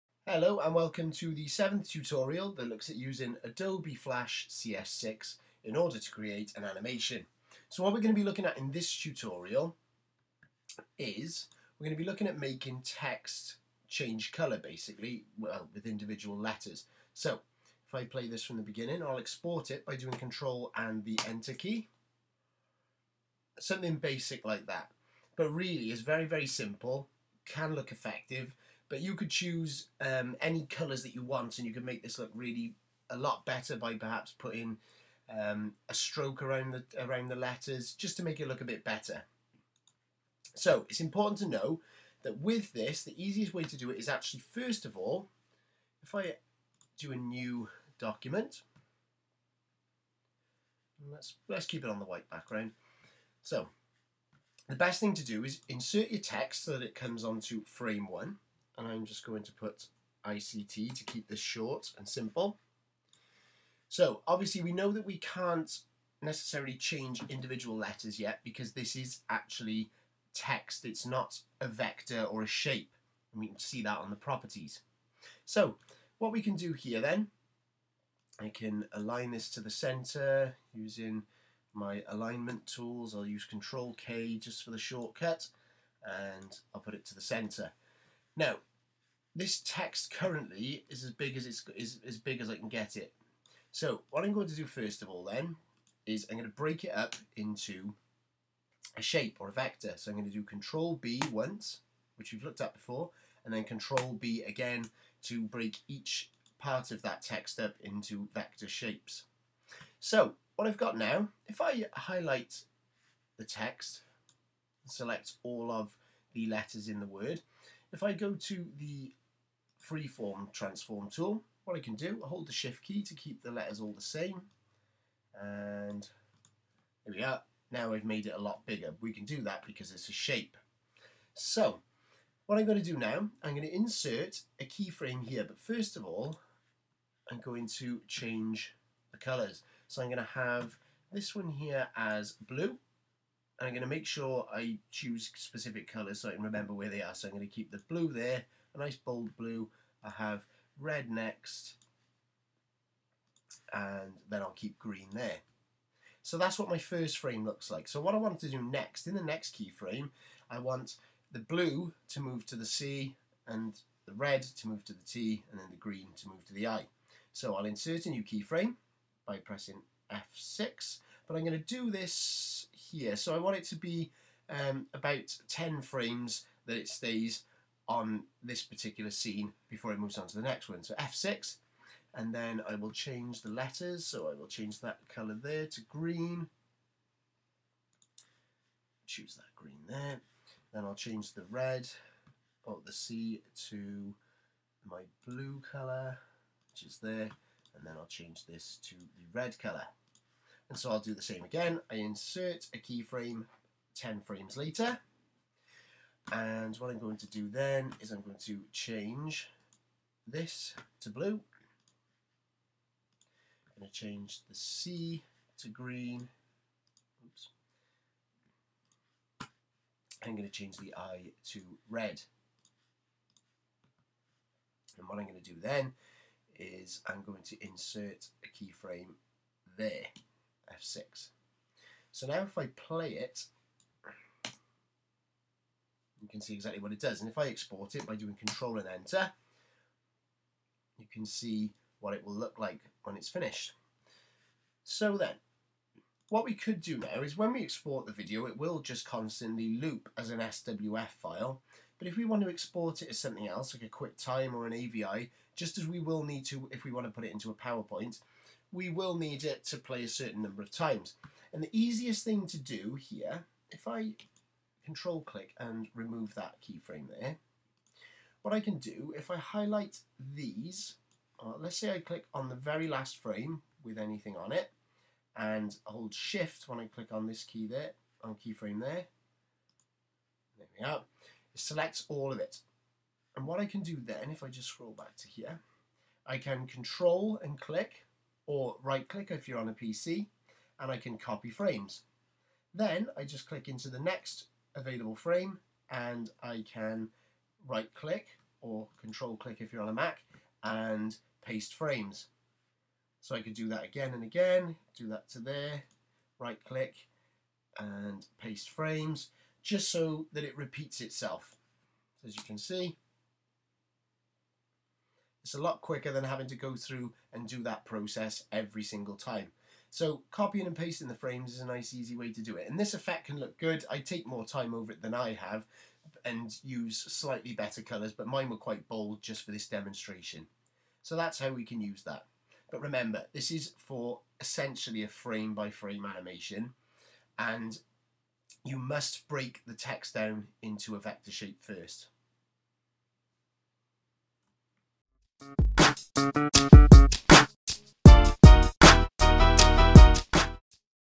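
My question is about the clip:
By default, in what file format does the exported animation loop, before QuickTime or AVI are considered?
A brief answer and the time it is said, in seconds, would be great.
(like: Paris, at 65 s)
SWF, at 250 s.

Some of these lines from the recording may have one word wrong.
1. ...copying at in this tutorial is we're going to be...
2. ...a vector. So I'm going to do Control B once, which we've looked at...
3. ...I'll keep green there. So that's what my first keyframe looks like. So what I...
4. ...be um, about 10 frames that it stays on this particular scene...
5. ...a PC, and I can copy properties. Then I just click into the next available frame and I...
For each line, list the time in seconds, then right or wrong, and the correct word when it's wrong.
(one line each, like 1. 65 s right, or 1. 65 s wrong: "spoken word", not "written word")
1. 8 s wrong: "looking", not "copying"
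2. 99 s right
3. 154 s wrong: "frame", not "keyframe"
4. 173 s right
5. 289 s wrong: "frames", not "properties".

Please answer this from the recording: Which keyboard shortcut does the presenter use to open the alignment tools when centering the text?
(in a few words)
Control K.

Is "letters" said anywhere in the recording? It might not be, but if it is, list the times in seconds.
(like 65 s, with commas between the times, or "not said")
16 s, 37 s, 67 s, 116 s, 123 s, 183 s.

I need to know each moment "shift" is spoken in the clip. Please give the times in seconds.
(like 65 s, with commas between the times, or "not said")
122 s, 276 s.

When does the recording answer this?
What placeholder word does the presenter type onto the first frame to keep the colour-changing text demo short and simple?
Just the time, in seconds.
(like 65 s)
60 s.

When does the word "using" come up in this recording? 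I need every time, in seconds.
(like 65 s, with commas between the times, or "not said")
2 s, 80 s.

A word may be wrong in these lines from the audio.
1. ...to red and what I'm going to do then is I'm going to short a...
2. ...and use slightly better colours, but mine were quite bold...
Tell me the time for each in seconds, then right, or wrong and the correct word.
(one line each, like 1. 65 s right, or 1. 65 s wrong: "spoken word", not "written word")
1. 221 s wrong: "insert", not "short"
2. 326 s right.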